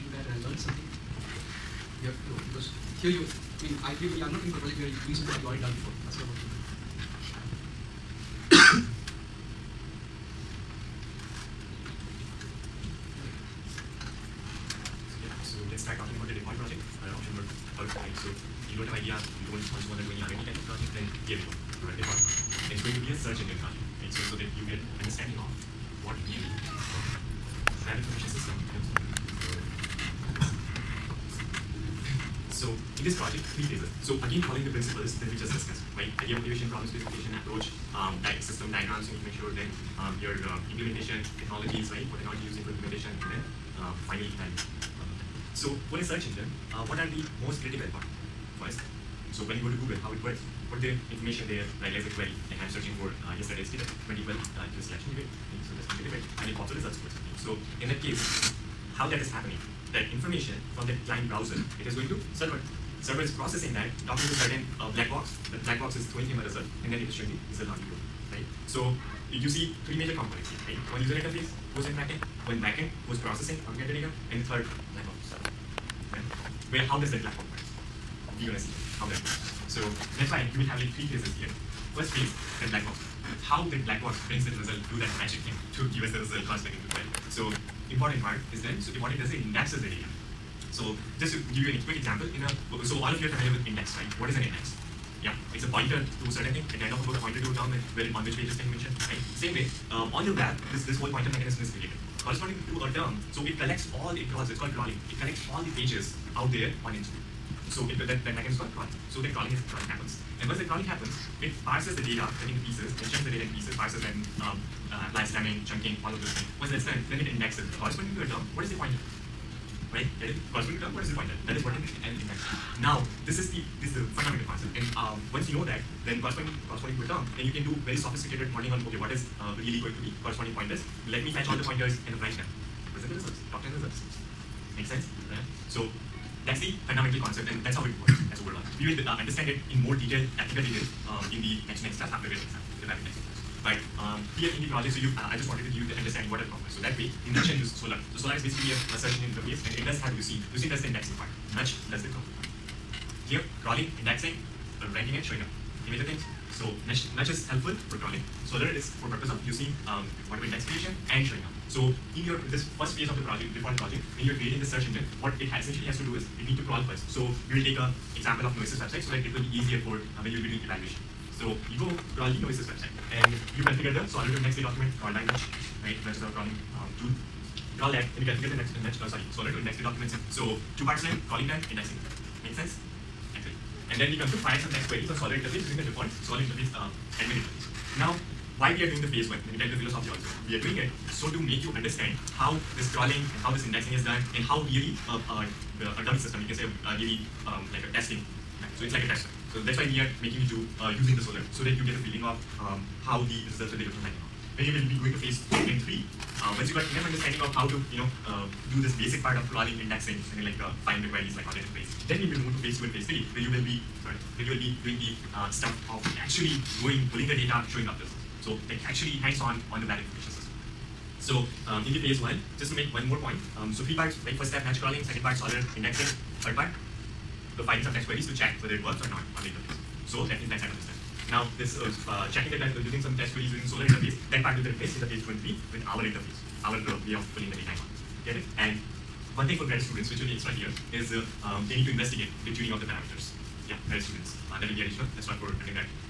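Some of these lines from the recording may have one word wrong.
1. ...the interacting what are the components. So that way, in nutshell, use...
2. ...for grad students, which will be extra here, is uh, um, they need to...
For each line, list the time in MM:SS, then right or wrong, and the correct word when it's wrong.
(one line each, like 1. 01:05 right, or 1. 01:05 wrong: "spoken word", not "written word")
1. 02:25 wrong: "understanding", not "interacting"
2. 03:59 right.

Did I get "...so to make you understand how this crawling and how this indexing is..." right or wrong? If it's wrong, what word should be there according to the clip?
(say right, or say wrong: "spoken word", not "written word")
right.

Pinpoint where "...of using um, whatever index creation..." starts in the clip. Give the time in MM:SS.
02:39.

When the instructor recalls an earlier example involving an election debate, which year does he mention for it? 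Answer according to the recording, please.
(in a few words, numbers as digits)
2012.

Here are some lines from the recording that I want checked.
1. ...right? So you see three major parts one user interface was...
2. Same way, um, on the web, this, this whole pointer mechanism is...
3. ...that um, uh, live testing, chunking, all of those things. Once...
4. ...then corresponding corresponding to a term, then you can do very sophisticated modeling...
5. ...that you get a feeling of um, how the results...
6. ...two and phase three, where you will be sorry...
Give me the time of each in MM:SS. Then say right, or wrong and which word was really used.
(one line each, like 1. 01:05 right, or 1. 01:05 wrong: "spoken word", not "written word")
1. 01:08 wrong: "components", not "parts"
2. 01:39 right
3. 01:54 wrong: "slamming", not "testing"
4. 02:06 right
5. 03:21 right
6. 03:32 right.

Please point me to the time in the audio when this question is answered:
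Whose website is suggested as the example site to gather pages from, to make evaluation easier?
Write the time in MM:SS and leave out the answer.
02:48.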